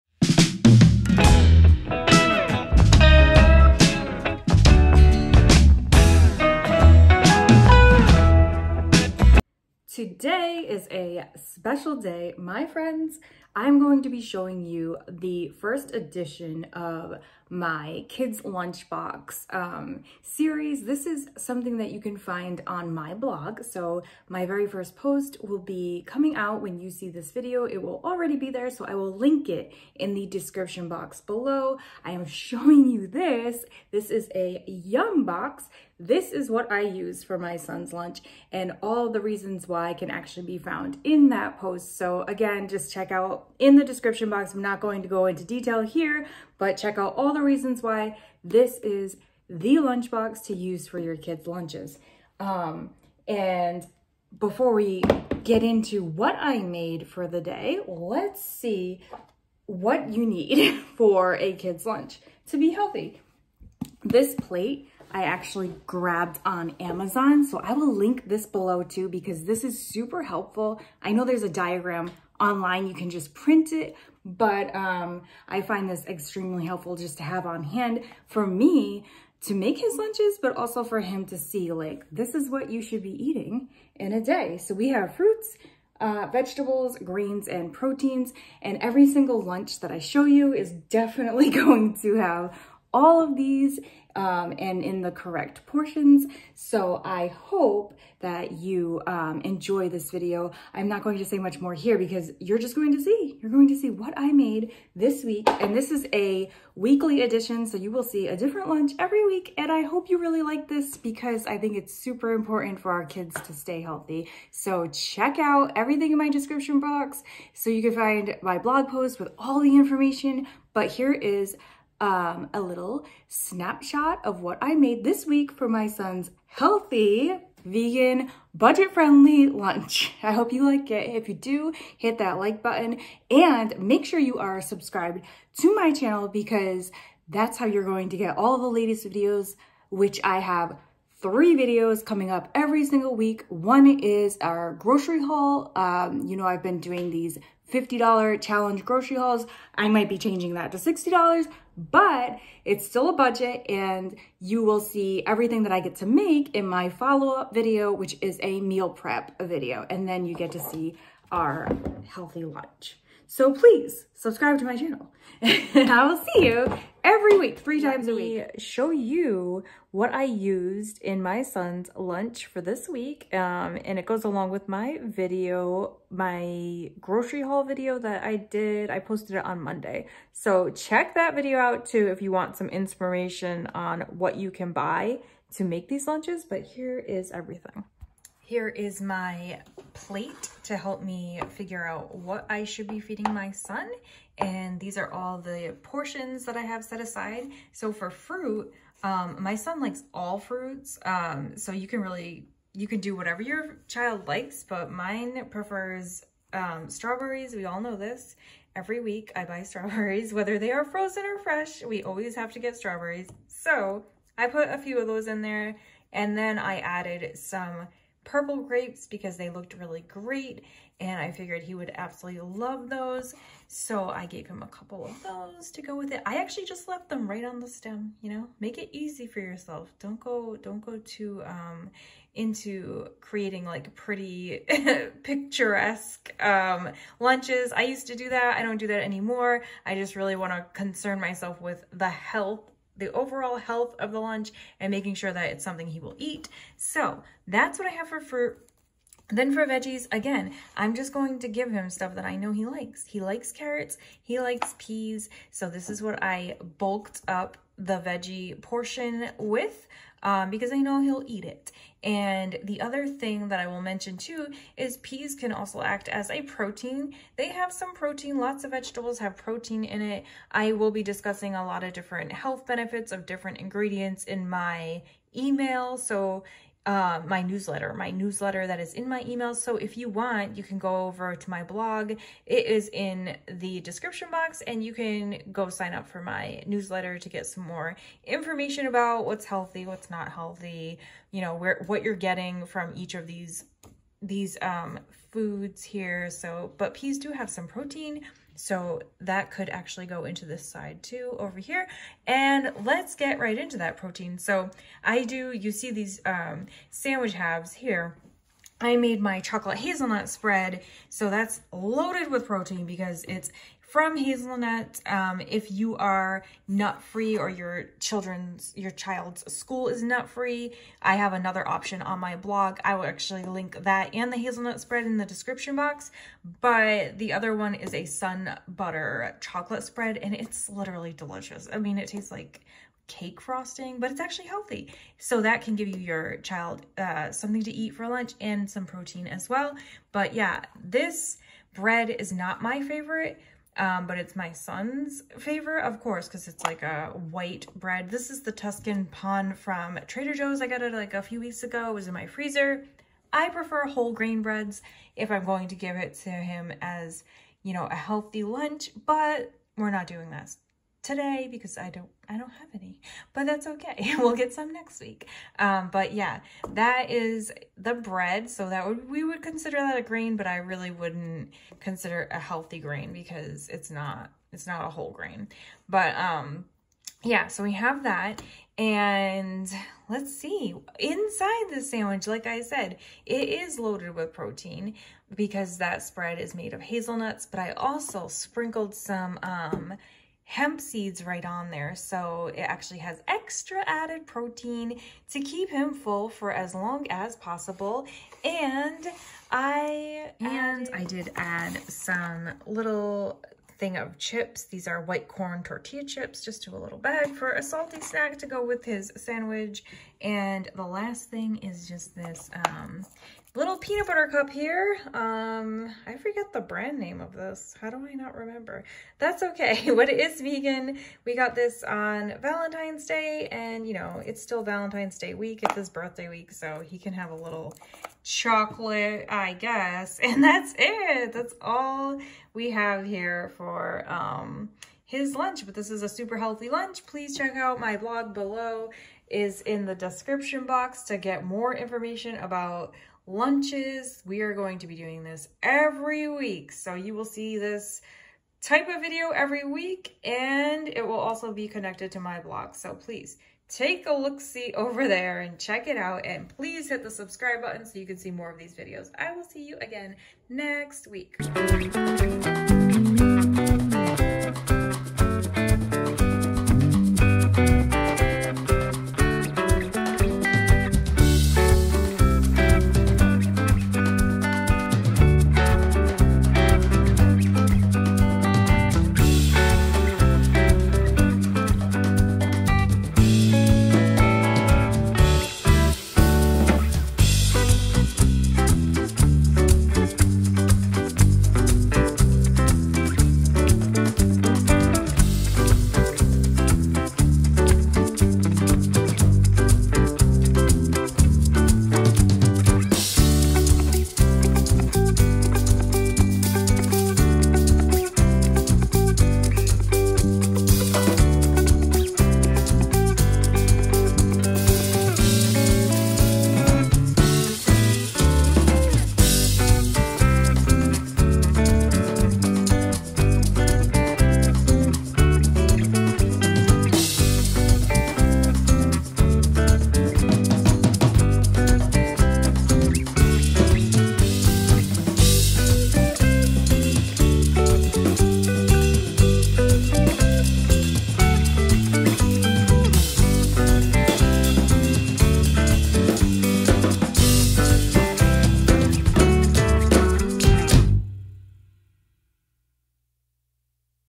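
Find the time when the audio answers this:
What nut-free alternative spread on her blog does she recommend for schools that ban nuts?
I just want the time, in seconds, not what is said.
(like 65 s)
328 s.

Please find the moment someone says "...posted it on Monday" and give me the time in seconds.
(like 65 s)
178 s.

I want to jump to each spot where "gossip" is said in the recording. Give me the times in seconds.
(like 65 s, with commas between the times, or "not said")
not said.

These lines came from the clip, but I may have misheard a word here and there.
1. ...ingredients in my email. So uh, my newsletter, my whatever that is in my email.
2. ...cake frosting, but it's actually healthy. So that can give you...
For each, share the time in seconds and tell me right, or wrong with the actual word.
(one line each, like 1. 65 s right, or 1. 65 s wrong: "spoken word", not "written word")
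1. 273 s wrong: "newsletter", not "whatever"
2. 333 s right.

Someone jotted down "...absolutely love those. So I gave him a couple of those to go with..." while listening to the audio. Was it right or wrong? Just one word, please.
right.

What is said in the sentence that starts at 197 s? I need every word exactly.
So for fruit, um, my son likes all fruits.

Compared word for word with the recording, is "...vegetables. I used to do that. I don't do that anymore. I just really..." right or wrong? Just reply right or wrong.
wrong.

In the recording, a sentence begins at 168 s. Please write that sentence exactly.
show you what I used in my son's lunch for this week.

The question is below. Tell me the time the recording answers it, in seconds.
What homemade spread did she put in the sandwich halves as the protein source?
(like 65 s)
309 s.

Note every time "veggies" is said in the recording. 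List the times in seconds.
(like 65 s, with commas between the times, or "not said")
249 s, 257 s.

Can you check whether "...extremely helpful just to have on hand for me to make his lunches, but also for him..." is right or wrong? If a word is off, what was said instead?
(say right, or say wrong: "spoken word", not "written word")
right.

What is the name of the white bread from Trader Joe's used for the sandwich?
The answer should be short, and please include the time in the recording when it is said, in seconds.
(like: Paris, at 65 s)
Tuscan Pane, at 348 s.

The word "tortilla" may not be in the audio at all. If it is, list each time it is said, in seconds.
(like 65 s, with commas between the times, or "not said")
405 s.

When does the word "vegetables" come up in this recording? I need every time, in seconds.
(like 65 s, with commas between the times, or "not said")
86 s, 268 s.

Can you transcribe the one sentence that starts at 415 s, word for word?
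Um, I forget the brand name of this.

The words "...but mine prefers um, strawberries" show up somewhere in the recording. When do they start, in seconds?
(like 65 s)
204 s.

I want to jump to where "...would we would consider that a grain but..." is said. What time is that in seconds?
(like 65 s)
368 s.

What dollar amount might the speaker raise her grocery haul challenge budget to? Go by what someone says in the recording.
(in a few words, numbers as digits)
$60.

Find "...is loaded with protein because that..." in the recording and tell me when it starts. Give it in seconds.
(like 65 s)
383 s.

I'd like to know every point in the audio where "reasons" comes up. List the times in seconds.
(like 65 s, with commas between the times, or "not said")
39 s, 47 s.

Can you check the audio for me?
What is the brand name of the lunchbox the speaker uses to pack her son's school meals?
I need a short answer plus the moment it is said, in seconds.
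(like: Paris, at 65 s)
Yumbox, at 34 s.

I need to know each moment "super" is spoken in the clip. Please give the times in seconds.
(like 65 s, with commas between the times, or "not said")
69 s, 111 s, 436 s.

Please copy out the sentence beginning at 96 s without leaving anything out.
So I hope that you um, enjoy this video.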